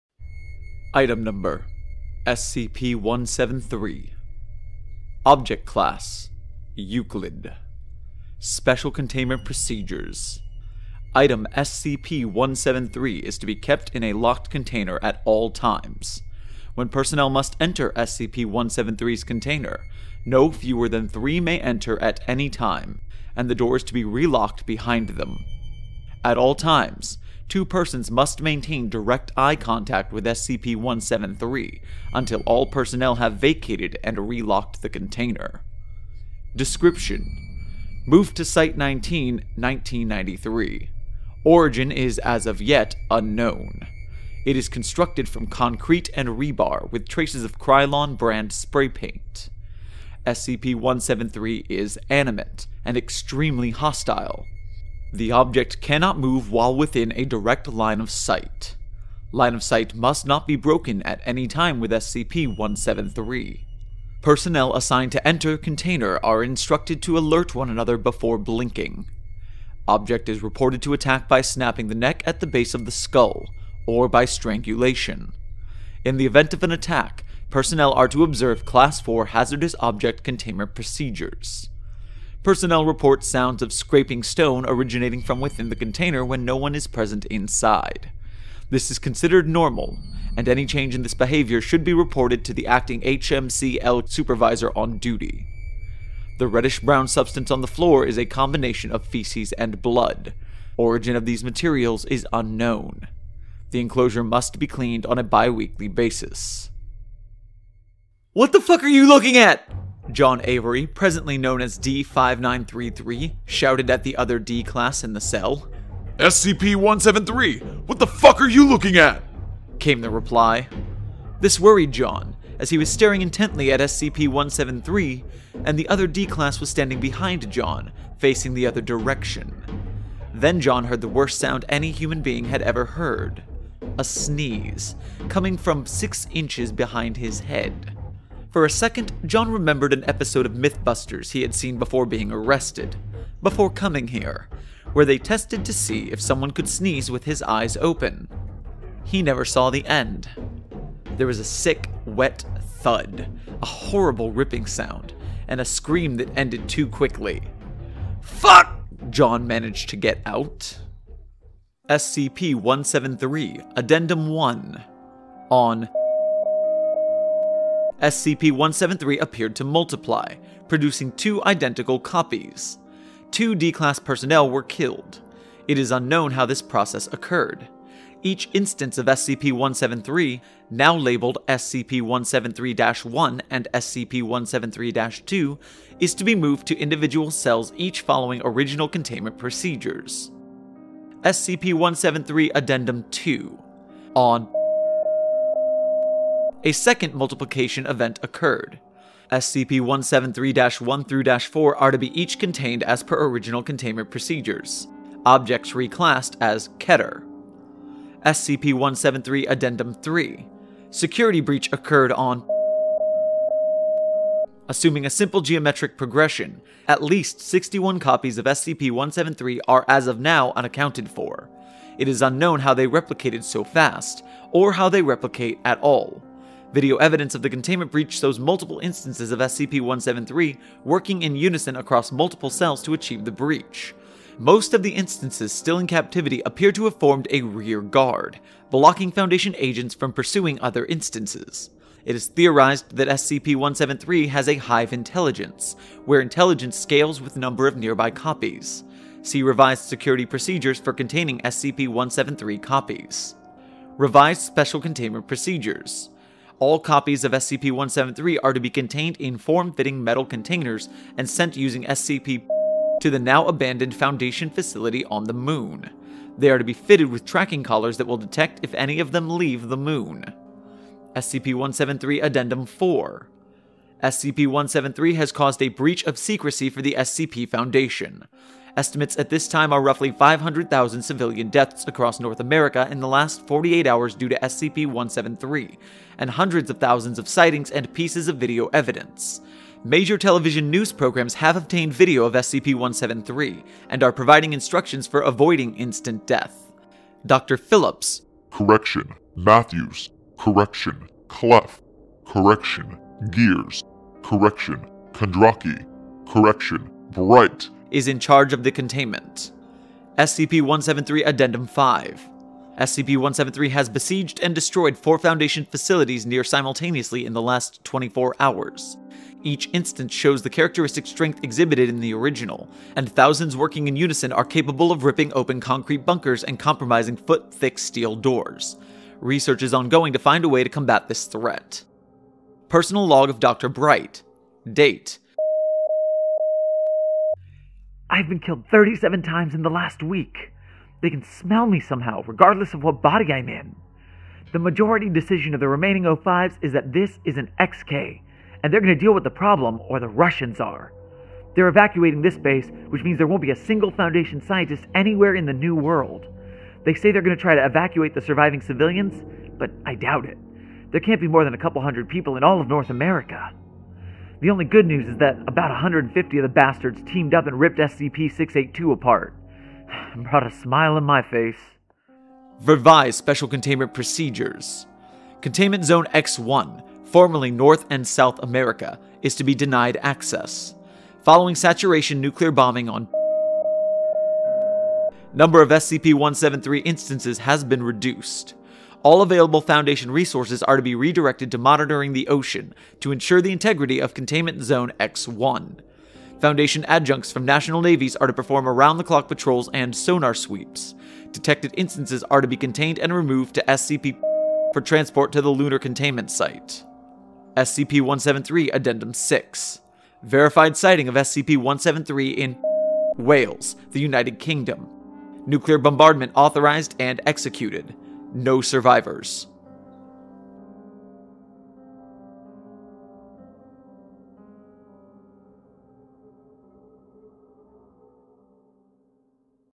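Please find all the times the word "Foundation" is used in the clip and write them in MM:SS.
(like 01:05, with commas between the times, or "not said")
03:59, 04:23, 04:37, 05:15, 05:53, 06:29, 06:36.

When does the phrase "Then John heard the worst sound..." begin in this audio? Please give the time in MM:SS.
02:10.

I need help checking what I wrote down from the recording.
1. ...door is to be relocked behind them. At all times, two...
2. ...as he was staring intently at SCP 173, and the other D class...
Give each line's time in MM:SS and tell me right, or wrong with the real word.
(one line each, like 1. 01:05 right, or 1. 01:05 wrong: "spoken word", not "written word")
1. 00:23 right
2. 02:02 right.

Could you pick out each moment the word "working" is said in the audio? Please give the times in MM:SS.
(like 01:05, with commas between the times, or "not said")
03:50, 05:23.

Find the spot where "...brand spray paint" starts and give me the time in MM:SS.
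00:48.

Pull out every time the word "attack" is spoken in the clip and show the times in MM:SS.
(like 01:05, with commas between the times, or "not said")
01:10, 01:16.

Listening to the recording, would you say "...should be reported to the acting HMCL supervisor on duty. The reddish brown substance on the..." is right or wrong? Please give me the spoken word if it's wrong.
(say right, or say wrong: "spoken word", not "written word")
right.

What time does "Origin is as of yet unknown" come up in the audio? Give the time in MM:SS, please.
00:41.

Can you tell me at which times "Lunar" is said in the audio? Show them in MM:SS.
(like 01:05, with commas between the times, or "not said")
06:45.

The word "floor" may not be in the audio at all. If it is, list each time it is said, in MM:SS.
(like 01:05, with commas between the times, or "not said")
01:37.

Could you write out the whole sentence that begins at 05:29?
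Research is ongoing to find a way to combat this threat.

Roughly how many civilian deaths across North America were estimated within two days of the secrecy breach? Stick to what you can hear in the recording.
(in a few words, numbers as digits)
500,000.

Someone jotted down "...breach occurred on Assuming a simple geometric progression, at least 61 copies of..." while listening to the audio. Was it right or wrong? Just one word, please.
right.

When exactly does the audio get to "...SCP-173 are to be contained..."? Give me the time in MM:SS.
04:17.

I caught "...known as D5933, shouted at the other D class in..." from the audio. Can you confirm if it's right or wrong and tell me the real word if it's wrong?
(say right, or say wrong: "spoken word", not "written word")
right.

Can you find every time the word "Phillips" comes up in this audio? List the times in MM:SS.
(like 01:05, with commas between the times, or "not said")
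04:57.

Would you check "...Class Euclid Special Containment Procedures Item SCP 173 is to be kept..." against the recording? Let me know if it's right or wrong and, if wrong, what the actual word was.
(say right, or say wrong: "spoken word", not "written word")
right.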